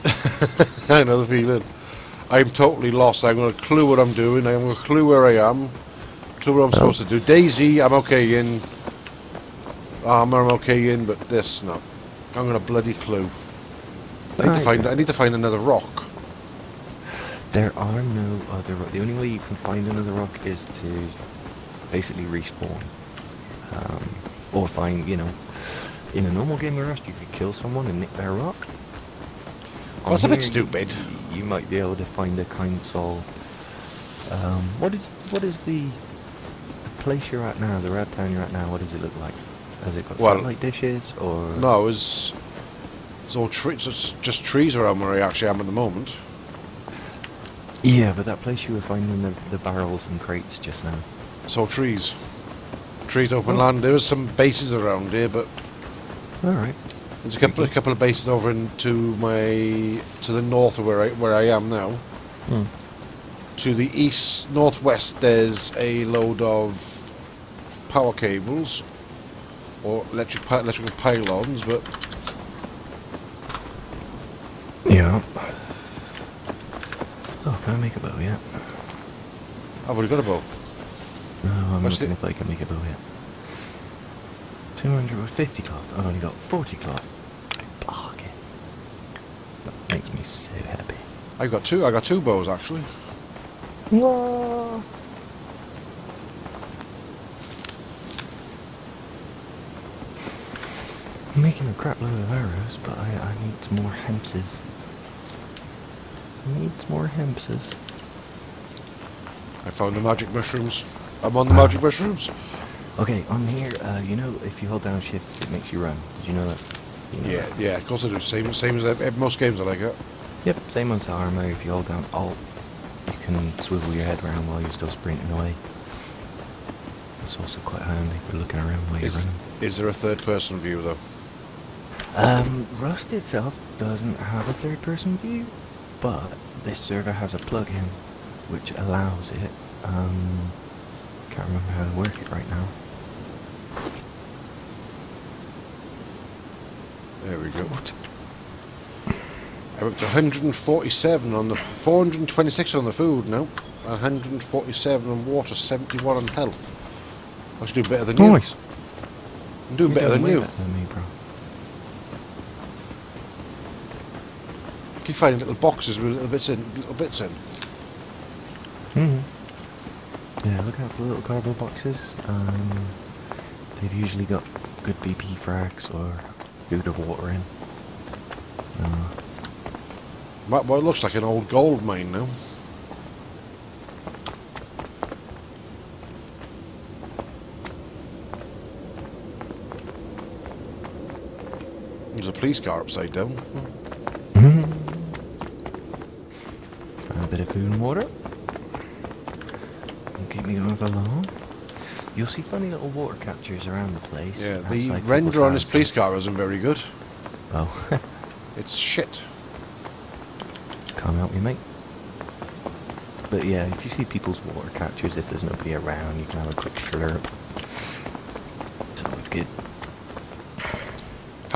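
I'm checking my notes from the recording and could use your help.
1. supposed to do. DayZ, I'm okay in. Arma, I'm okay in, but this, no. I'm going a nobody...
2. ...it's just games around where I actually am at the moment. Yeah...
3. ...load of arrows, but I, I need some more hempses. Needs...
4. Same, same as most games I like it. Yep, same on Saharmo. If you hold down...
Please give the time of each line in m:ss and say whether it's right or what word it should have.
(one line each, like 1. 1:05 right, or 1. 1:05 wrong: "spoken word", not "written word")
1. 0:06 wrong: "bloody", not "nobody"
2. 0:43 wrong: "trees", not "games"
3. 1:42 right
4. 1:58 right.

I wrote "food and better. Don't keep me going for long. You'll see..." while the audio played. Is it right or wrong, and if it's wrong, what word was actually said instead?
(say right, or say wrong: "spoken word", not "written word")
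wrong: "water", not "better".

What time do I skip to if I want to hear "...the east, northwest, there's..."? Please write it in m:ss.
1:03.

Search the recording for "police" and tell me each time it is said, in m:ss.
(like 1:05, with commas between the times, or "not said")
3:12, 3:25.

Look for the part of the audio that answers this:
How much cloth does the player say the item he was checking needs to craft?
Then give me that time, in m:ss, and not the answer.
1:24.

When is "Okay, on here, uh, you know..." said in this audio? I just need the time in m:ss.
1:52.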